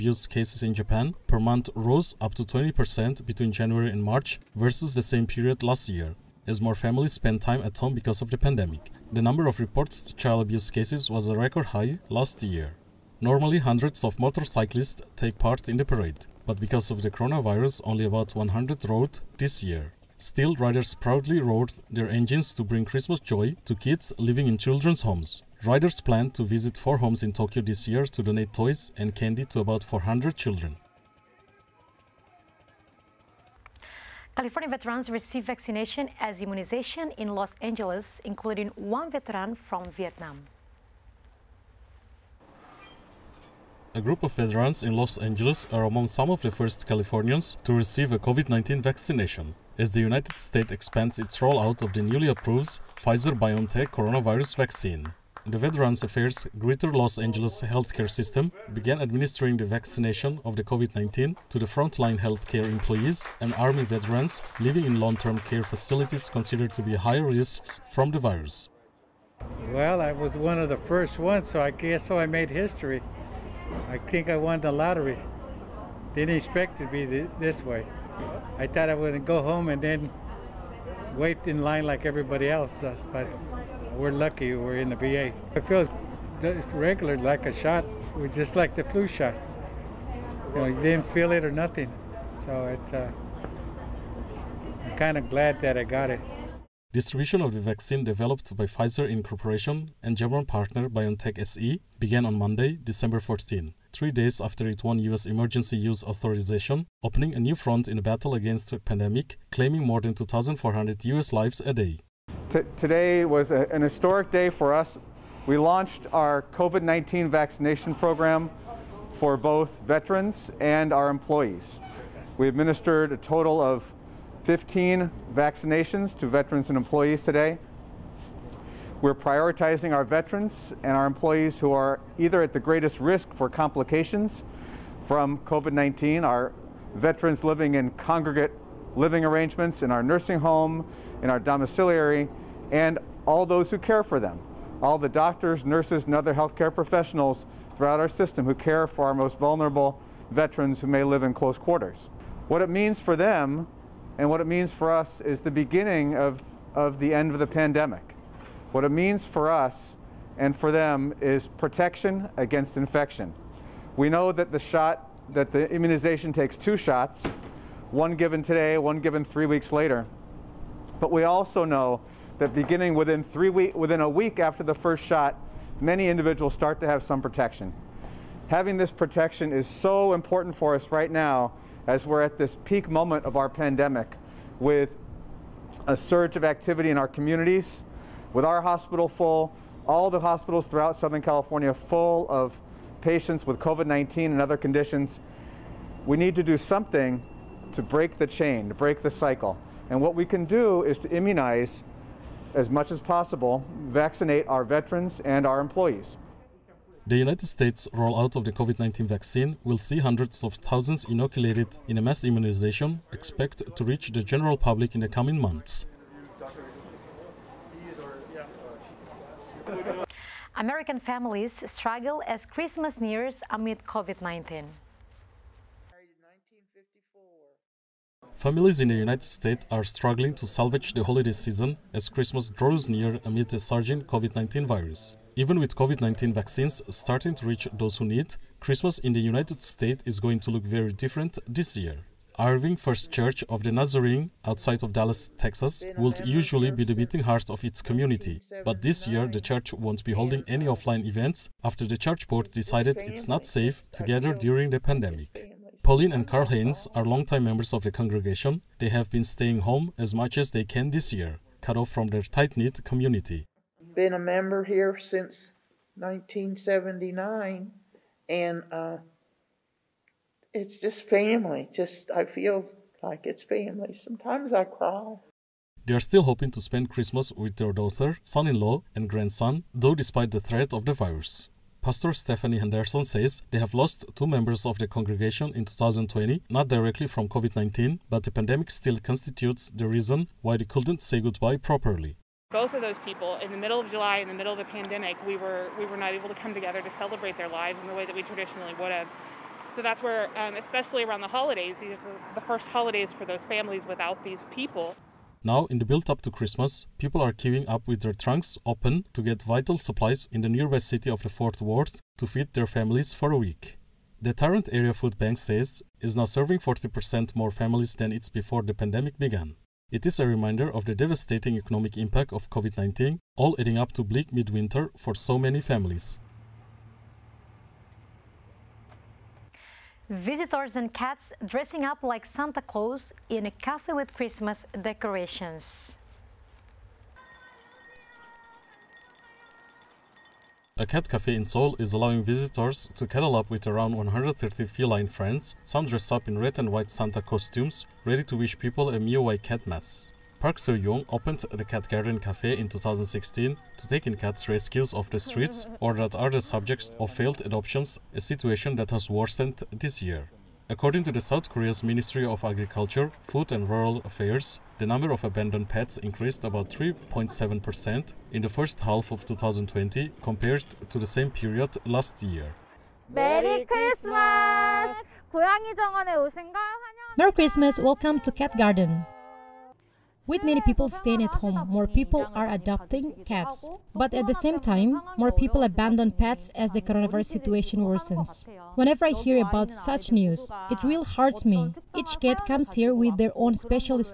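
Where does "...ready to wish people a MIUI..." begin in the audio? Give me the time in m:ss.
5:48.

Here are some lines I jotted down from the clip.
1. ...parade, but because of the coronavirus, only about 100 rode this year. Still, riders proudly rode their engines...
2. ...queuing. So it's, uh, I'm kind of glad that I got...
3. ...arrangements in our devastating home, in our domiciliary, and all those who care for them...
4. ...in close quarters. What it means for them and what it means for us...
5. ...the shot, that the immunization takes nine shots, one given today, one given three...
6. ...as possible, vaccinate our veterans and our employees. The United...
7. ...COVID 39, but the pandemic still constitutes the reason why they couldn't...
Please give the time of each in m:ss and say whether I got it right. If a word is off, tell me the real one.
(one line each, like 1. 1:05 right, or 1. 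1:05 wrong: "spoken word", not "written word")
1. 0:15 right
2. 1:31 wrong: "nothing", not "queuing"
3. 2:19 wrong: "nursing", not "devastating"
4. 2:31 right
5. 2:44 wrong: "two", not "nine"
6. 3:22 right
7. 4:47 wrong: "19", not "39".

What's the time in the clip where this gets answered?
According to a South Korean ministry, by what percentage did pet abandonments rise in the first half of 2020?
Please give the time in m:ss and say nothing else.
6:06.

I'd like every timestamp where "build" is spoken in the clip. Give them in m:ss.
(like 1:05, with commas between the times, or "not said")
5:05.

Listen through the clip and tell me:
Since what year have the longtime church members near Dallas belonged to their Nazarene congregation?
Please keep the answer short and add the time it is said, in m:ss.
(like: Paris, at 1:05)
1979, at 4:24.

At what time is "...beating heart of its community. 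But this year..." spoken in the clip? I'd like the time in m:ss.
4:06.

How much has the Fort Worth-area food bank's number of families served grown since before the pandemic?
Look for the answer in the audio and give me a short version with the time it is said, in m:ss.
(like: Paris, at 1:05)
40%, at 5:16.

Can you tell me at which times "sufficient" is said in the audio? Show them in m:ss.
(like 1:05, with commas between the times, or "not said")
not said.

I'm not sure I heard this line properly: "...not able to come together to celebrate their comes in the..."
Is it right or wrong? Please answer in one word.
wrong.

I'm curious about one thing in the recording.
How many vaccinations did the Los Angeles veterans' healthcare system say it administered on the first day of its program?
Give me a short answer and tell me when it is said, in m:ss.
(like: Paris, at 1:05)
15, at 2:03.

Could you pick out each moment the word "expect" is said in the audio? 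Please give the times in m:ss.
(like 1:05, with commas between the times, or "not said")
1:16, 3:33.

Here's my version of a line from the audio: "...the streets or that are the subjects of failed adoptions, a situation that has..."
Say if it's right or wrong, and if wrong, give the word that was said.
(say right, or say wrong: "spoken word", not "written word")
right.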